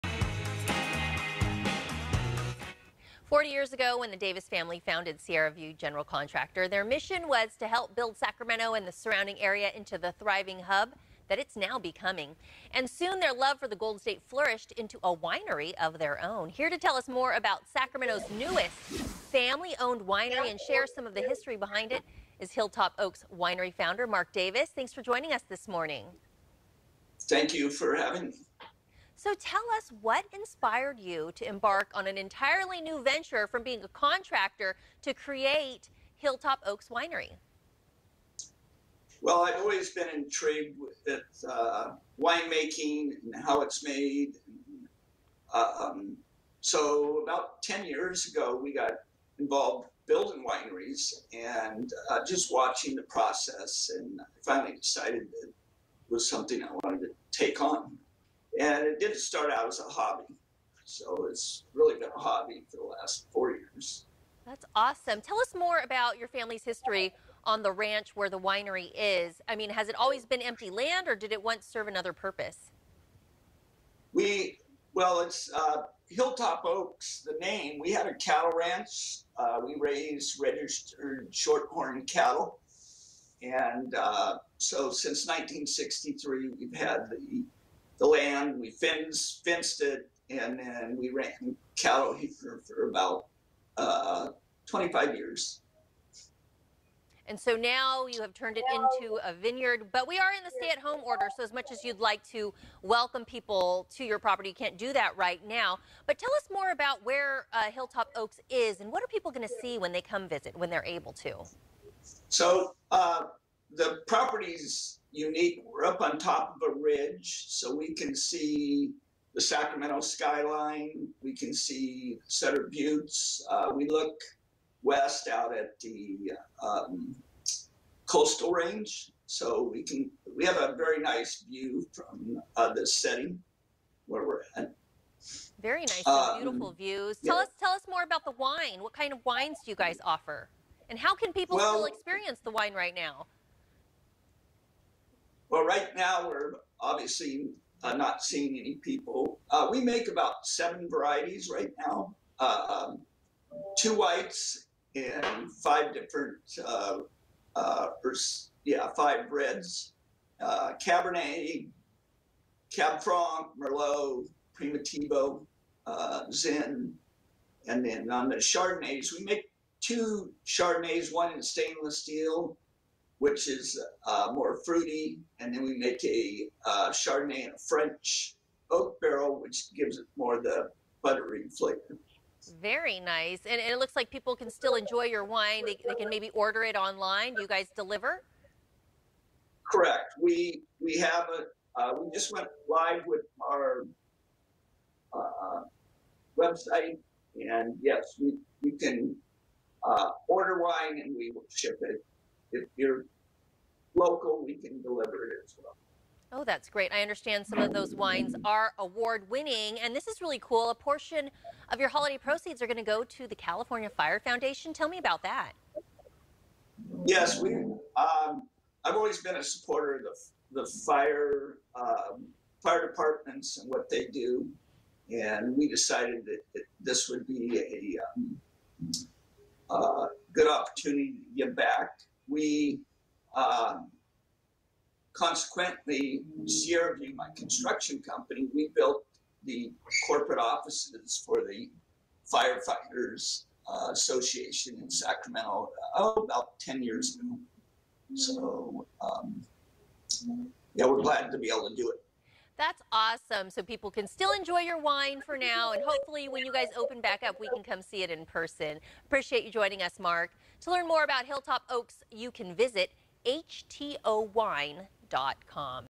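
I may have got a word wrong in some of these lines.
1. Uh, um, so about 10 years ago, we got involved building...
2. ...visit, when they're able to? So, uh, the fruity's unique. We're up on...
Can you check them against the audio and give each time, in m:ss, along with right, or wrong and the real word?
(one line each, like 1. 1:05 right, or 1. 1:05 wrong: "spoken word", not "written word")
1. 0:45 right
2. 1:50 wrong: "property", not "fruity".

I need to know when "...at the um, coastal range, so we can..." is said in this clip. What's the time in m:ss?
2:05.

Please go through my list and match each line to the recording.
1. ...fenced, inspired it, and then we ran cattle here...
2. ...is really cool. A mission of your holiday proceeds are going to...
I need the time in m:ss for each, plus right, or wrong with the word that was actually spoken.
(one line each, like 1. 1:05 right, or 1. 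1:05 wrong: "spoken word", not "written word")
1. 1:28 wrong: "fenced", not "inspired"
2. 3:30 wrong: "portion", not "mission".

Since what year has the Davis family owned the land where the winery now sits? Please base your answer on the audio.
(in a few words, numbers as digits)
1963.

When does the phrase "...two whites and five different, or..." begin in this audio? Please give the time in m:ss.
2:33.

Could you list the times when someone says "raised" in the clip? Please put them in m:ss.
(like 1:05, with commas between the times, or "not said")
1:19.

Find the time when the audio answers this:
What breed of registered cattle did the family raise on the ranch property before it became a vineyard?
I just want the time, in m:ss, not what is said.
1:21.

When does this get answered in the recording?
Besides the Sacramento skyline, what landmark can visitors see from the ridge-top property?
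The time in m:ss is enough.
2:02.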